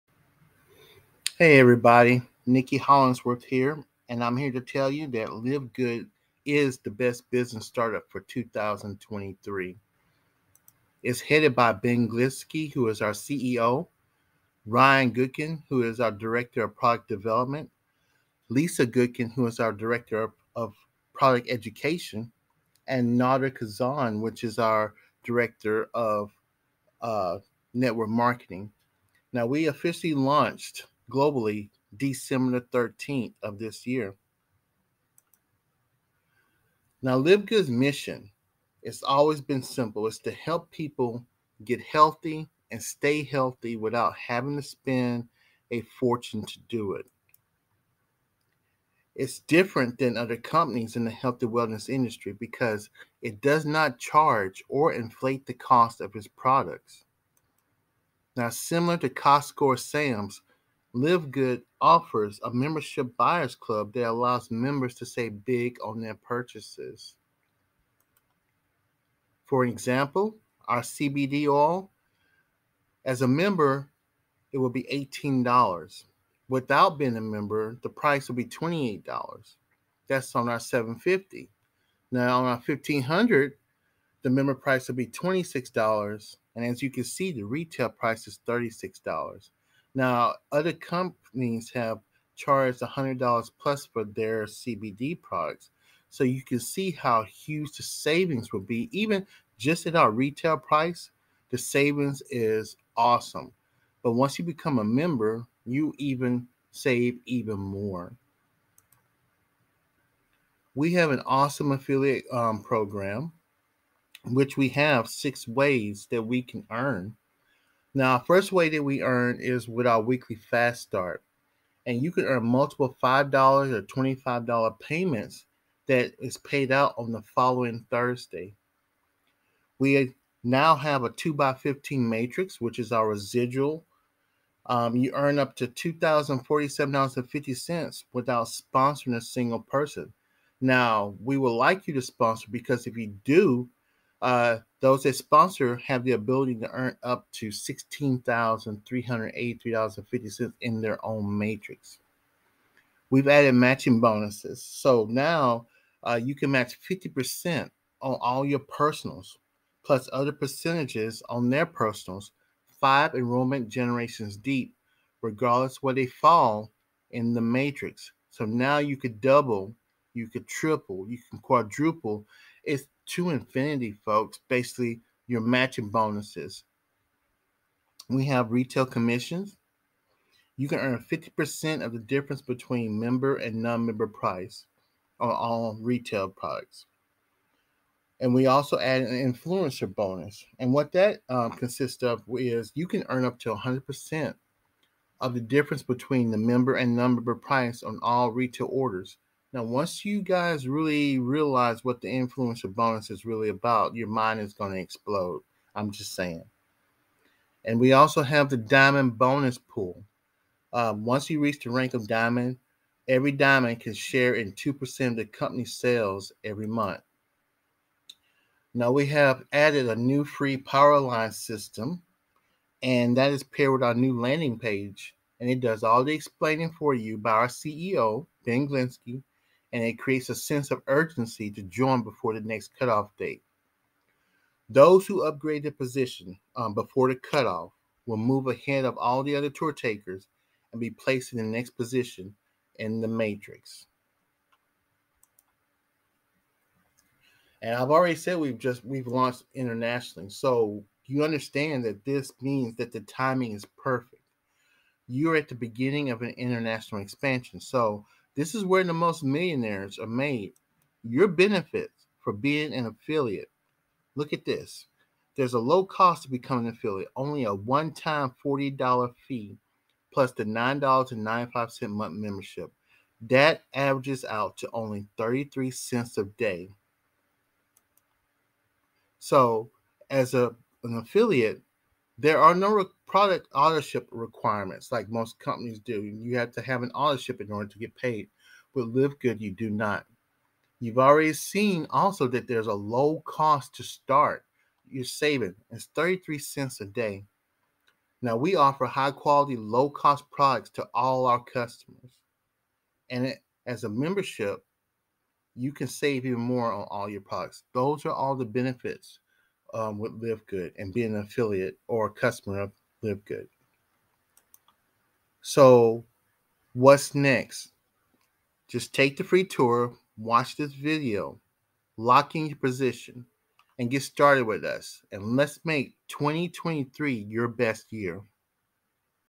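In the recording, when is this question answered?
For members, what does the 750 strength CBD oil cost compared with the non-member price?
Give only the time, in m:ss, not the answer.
1:14.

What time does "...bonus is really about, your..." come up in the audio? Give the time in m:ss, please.
3:22.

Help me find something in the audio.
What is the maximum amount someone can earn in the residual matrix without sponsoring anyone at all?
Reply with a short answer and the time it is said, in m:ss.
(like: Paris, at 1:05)
$2,047.50, at 2:15.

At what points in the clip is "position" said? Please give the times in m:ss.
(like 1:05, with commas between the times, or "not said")
3:55, 4:01, 5:22.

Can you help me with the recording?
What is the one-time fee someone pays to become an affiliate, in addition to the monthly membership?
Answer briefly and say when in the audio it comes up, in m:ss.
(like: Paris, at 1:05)
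$40, at 4:28.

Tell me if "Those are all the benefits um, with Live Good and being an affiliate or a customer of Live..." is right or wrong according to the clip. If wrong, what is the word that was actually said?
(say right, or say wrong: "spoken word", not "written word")
right.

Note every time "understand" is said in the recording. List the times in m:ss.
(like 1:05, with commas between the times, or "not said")
4:11.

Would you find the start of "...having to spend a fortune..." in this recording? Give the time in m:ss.
0:44.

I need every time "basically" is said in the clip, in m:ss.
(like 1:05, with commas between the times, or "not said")
2:54.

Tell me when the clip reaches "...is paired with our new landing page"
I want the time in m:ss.
3:43.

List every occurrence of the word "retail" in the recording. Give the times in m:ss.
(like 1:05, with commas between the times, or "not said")
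1:27, 1:40, 2:58, 3:05, 3:18.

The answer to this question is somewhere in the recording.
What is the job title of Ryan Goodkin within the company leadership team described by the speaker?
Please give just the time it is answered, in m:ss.
0:16.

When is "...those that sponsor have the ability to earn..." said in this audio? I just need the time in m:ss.
2:24.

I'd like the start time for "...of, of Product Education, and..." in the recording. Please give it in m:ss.
0:20.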